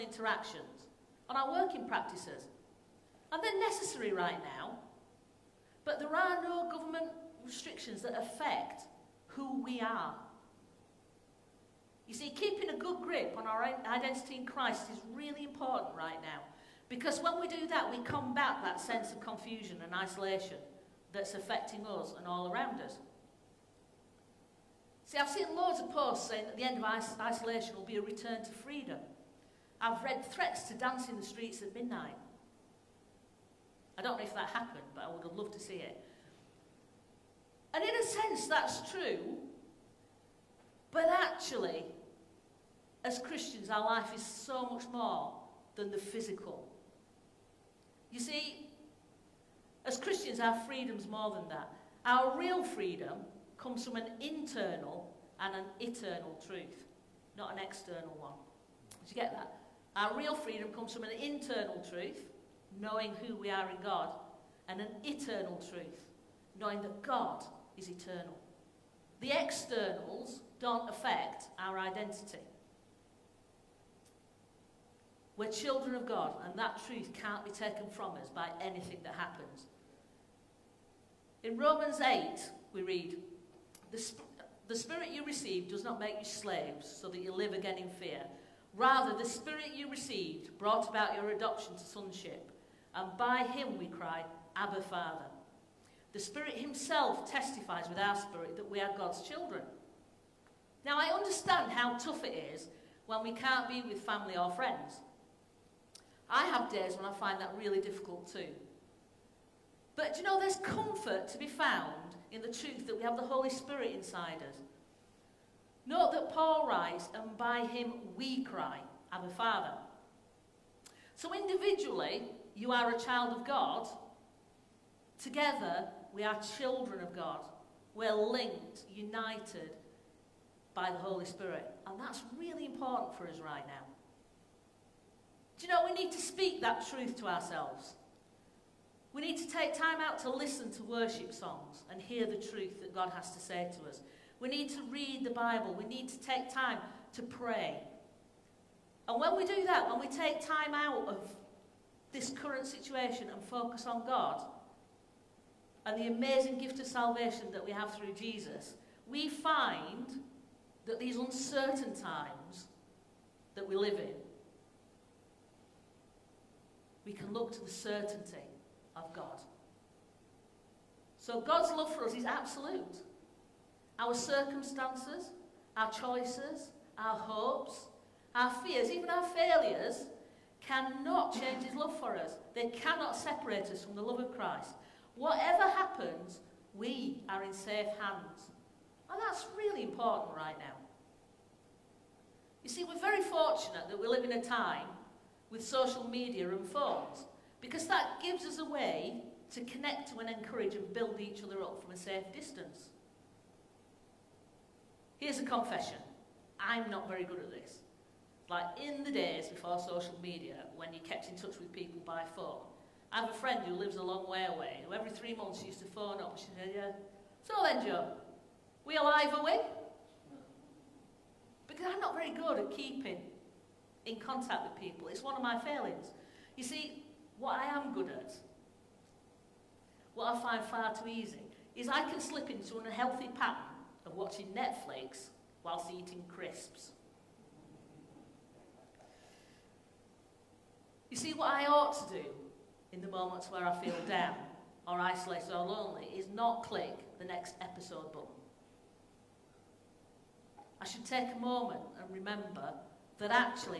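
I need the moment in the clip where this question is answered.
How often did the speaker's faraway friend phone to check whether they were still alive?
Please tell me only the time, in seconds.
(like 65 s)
214 s.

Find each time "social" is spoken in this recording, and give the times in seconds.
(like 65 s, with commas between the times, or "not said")
195 s, 209 s.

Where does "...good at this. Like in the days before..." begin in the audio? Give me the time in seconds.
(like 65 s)
207 s.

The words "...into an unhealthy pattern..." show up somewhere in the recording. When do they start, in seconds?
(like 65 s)
232 s.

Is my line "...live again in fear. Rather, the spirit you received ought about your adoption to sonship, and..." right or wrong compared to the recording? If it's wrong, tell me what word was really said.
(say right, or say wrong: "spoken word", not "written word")
wrong: "brought", not "ought".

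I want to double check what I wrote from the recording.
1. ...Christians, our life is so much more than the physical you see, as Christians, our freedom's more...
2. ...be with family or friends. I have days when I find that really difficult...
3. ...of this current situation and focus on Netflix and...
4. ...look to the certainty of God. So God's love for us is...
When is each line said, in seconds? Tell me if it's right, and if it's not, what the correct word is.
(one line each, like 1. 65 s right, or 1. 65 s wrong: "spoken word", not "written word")
1. 43 s right
2. 103 s right
3. 151 s wrong: "God", not "Netflix"
4. 167 s right.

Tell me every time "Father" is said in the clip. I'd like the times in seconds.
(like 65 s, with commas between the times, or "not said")
94 s, 119 s.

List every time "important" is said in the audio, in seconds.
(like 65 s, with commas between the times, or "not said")
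15 s, 132 s, 189 s.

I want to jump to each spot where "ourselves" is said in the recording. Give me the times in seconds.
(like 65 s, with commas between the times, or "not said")
137 s.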